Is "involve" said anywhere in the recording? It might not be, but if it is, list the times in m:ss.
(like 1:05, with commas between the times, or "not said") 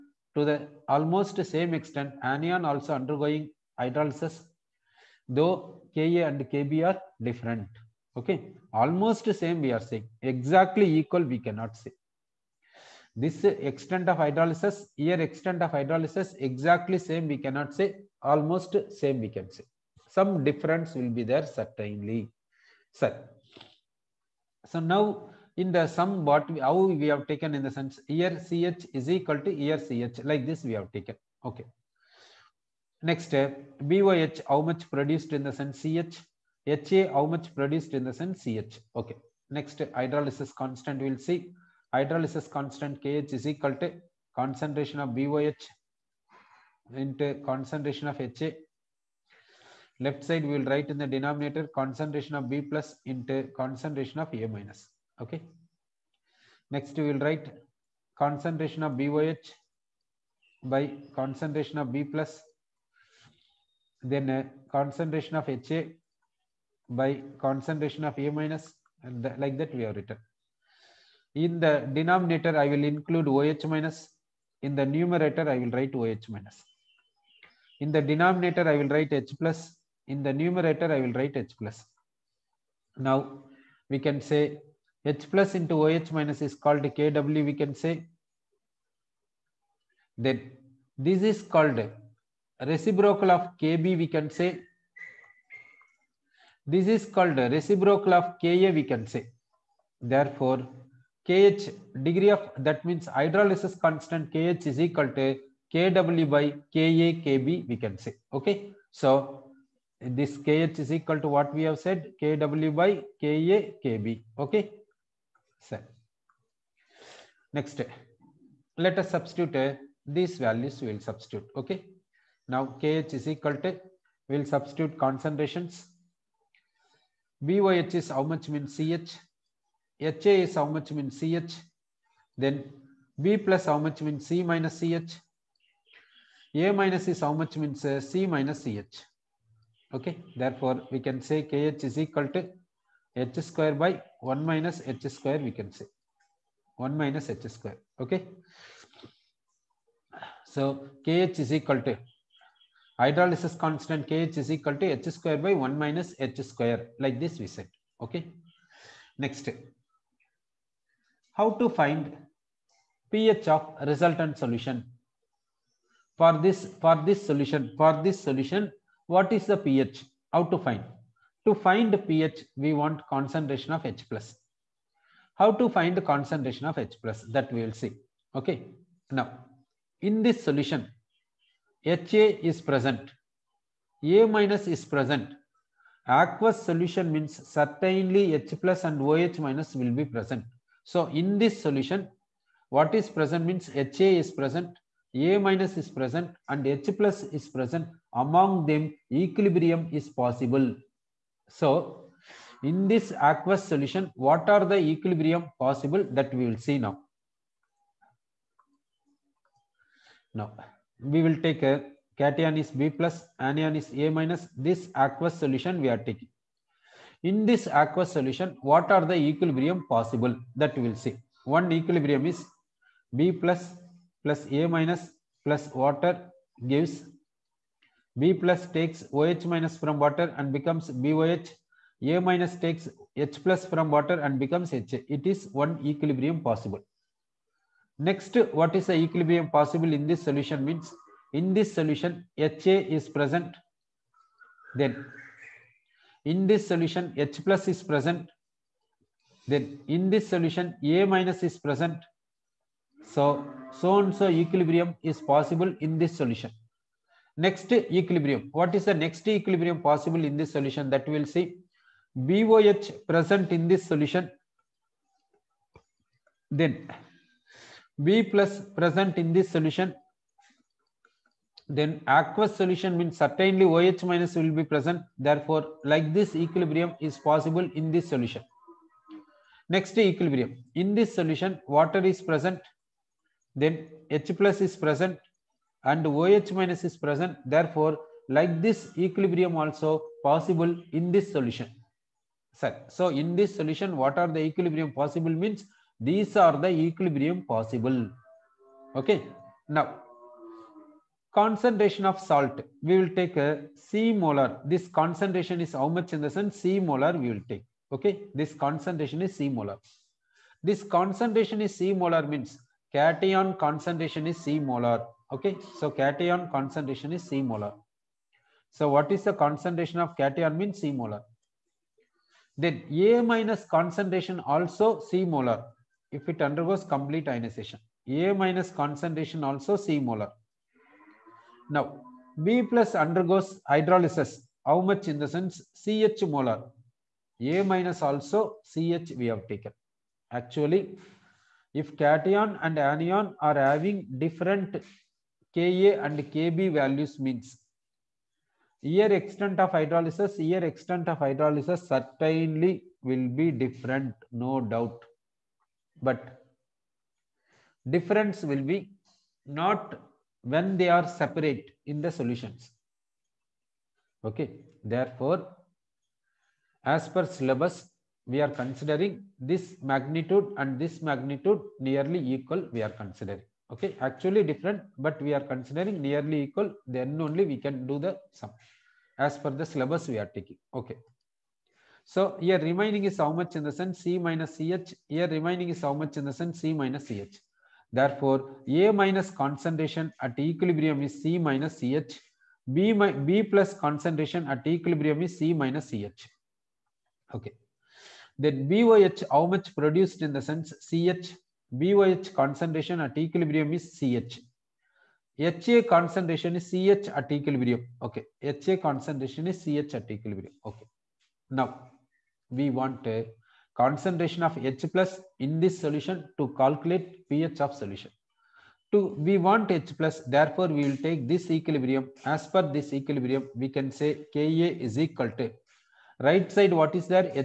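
not said.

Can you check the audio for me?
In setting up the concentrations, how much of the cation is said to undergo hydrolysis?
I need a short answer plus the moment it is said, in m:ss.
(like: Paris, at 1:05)
Ch molar, at 5:35.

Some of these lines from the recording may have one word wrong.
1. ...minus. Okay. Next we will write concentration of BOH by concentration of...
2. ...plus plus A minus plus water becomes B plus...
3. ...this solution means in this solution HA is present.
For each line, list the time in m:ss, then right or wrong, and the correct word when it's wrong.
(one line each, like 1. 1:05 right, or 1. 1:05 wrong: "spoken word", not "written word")
1. 0:54 right
2. 3:43 wrong: "gives", not "becomes"
3. 4:00 right.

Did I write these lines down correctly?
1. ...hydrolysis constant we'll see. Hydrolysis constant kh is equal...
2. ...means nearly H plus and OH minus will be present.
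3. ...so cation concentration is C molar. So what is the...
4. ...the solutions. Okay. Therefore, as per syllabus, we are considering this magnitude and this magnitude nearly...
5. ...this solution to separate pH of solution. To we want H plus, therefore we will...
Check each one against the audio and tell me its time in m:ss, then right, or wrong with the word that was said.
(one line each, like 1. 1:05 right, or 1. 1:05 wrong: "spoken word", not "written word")
1. 0:39 right
2. 3:07 wrong: "certainly", not "nearly"
3. 5:15 right
4. 6:01 right
5. 6:55 wrong: "calculate", not "separate".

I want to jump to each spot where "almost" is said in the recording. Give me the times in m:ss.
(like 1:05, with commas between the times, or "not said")
0:00, 0:08, 0:18.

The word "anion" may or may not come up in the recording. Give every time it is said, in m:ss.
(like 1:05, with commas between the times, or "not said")
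0:02, 3:33, 5:42.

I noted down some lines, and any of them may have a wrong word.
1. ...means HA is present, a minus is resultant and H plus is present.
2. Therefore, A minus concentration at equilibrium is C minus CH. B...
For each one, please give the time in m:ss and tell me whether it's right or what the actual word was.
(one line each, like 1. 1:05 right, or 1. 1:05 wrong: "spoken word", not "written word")
1. 3:13 wrong: "present", not "resultant"
2. 6:27 right.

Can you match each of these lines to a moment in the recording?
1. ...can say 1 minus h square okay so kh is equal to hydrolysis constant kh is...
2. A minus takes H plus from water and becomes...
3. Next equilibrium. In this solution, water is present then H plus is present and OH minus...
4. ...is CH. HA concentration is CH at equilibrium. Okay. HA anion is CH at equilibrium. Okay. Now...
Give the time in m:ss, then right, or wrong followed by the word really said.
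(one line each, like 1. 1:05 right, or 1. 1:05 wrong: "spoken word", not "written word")
1. 2:25 right
2. 3:52 right
3. 4:39 right
4. 6:43 wrong: "concentration", not "anion".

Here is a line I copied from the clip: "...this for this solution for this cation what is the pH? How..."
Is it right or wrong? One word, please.
wrong.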